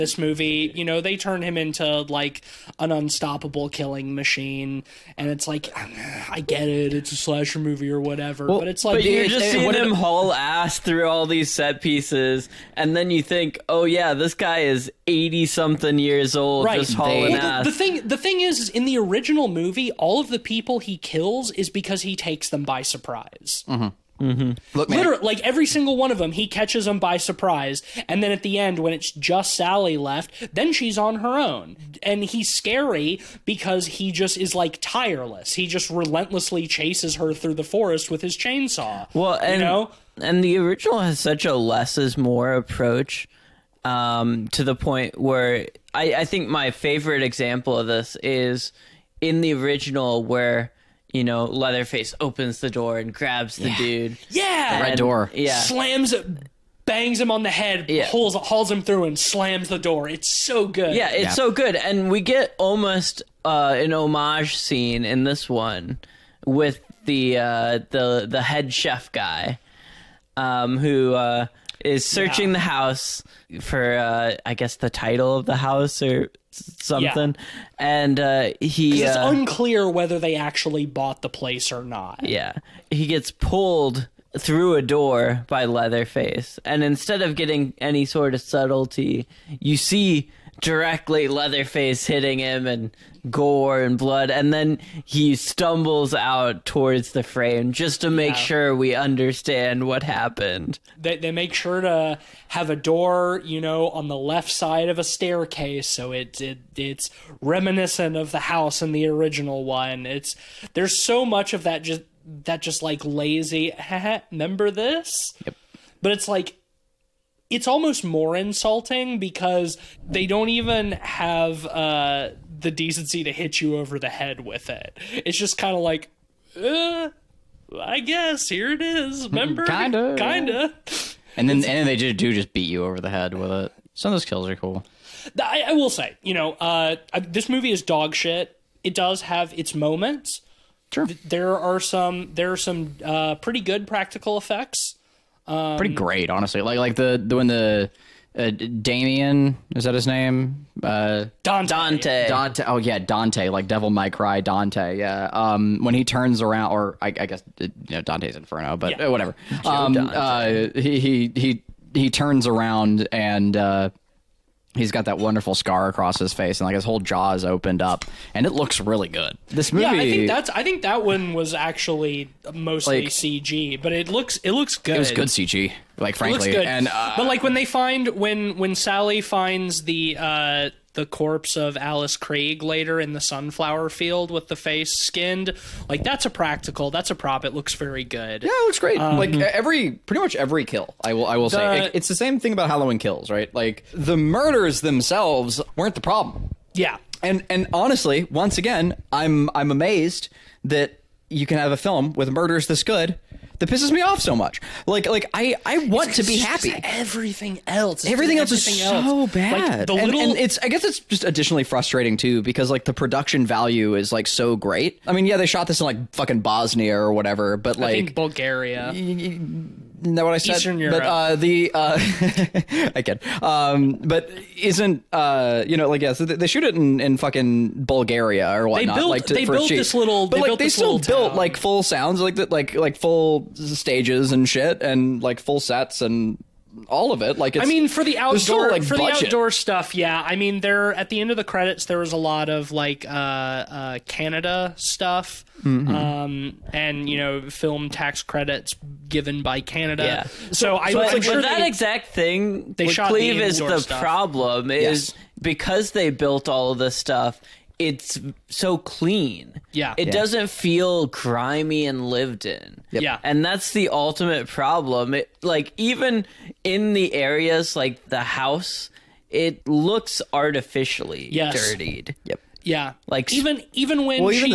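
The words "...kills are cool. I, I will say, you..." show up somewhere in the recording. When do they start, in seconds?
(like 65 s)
134 s.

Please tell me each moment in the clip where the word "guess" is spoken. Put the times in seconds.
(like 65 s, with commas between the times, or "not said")
74 s, 128 s, 157 s, 210 s.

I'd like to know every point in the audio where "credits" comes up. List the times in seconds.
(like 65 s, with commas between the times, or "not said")
241 s, 248 s.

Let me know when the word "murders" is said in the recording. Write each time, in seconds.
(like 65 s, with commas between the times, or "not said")
194 s, 202 s.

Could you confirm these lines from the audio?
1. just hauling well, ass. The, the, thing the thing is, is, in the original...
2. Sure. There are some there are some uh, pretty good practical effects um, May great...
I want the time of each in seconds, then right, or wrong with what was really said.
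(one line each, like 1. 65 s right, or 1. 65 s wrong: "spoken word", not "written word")
1. 16 s right
2. 140 s wrong: "Pretty", not "May".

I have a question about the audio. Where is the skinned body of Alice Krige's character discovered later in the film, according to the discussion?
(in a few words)
sunflower field.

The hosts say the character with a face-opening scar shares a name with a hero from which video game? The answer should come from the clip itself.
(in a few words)
Devil May Cry.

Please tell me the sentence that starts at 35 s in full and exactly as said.
He just relentlessly chases her through the forest with his chainsaw.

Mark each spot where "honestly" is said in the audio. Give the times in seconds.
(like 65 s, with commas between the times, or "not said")
146 s, 197 s.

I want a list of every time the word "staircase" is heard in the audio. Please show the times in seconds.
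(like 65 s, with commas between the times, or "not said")
105 s.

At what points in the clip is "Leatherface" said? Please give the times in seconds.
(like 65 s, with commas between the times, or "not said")
51 s, 85 s, 91 s.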